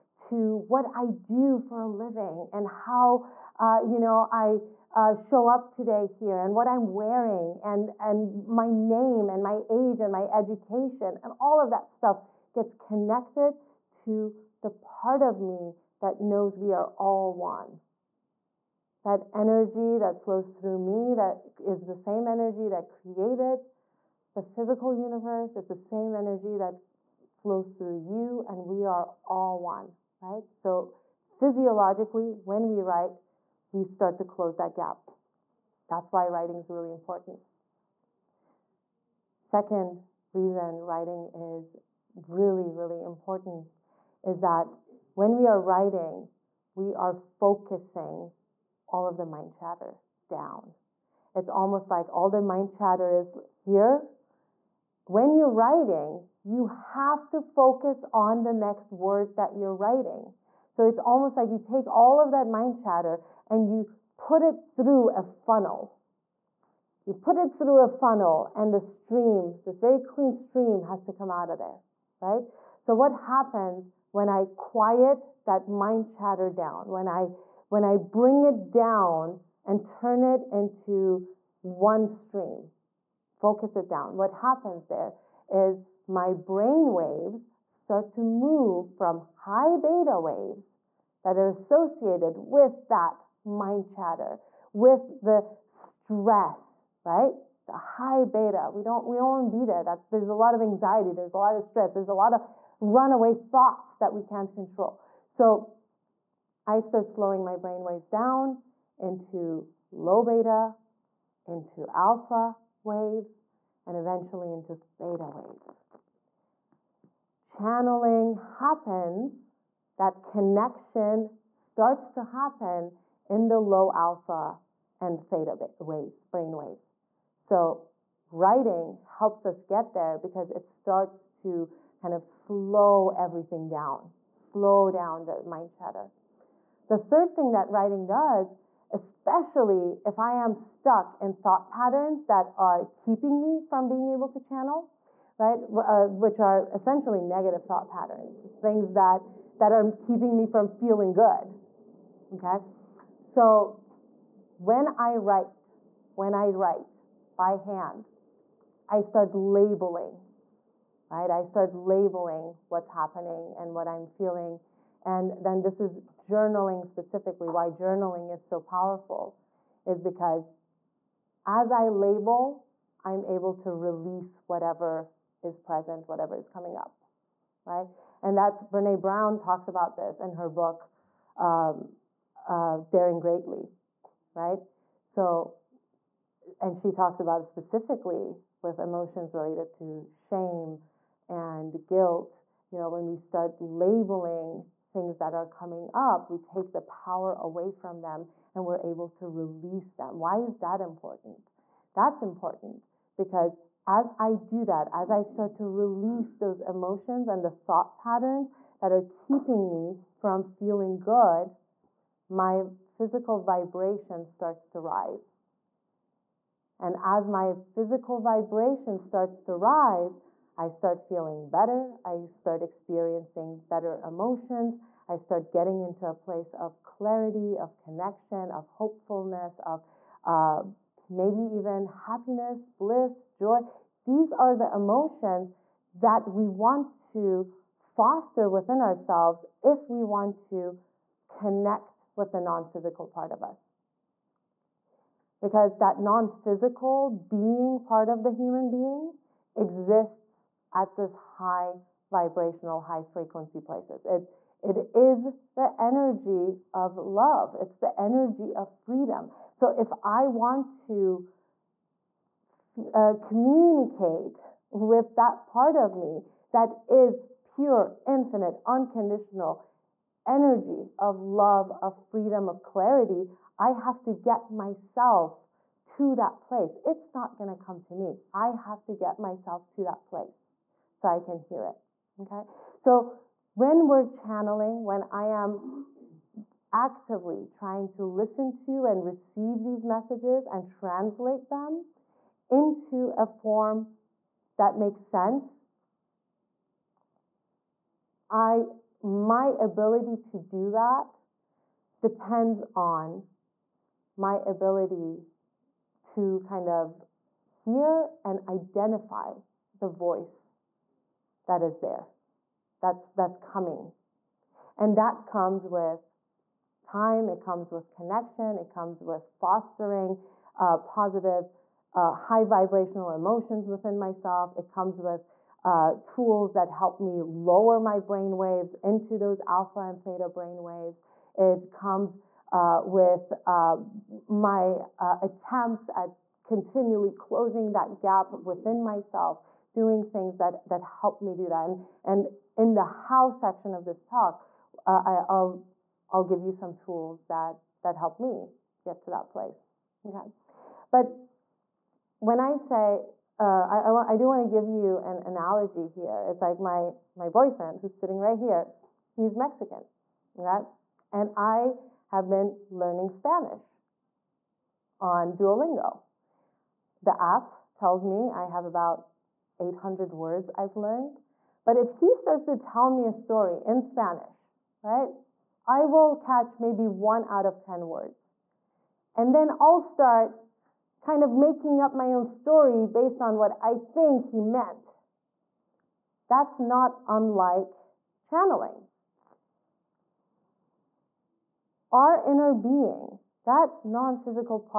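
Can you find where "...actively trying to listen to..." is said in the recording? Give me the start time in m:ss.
4:46.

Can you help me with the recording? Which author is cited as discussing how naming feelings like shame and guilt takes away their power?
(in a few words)
Brene Brown.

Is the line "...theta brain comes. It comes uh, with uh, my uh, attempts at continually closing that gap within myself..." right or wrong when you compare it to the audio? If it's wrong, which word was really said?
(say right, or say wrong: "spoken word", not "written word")
wrong: "waves", not "comes".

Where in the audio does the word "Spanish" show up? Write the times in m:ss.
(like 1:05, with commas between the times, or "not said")
6:03, 6:13.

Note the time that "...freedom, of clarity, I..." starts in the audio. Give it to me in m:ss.
4:31.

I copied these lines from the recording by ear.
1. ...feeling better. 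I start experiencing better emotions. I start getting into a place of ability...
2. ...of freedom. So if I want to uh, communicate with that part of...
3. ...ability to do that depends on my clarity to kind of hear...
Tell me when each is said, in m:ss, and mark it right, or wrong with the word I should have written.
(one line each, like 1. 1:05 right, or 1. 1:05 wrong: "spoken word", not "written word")
1. 3:41 wrong: "clarity", not "ability"
2. 4:18 right
3. 4:59 wrong: "ability", not "clarity".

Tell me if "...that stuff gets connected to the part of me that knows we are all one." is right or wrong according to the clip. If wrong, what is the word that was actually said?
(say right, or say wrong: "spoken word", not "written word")
right.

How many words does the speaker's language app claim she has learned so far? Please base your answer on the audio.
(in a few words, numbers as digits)
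800.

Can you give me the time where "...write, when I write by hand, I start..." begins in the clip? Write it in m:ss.
2:35.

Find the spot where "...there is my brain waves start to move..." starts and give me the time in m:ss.
1:24.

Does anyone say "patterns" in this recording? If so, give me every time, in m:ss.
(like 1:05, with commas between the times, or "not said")
2:21, 2:27, 3:27.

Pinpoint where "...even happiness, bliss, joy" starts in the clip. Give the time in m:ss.
3:51.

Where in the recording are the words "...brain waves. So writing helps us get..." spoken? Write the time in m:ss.
2:06.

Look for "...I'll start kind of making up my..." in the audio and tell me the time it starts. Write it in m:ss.
6:19.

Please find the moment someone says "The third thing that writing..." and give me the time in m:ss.
2:16.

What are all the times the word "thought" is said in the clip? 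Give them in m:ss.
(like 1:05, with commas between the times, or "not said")
1:43, 2:21, 2:27, 3:27.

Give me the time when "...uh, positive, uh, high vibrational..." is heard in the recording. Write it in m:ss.
5:20.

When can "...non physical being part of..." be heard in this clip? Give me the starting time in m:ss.
4:06.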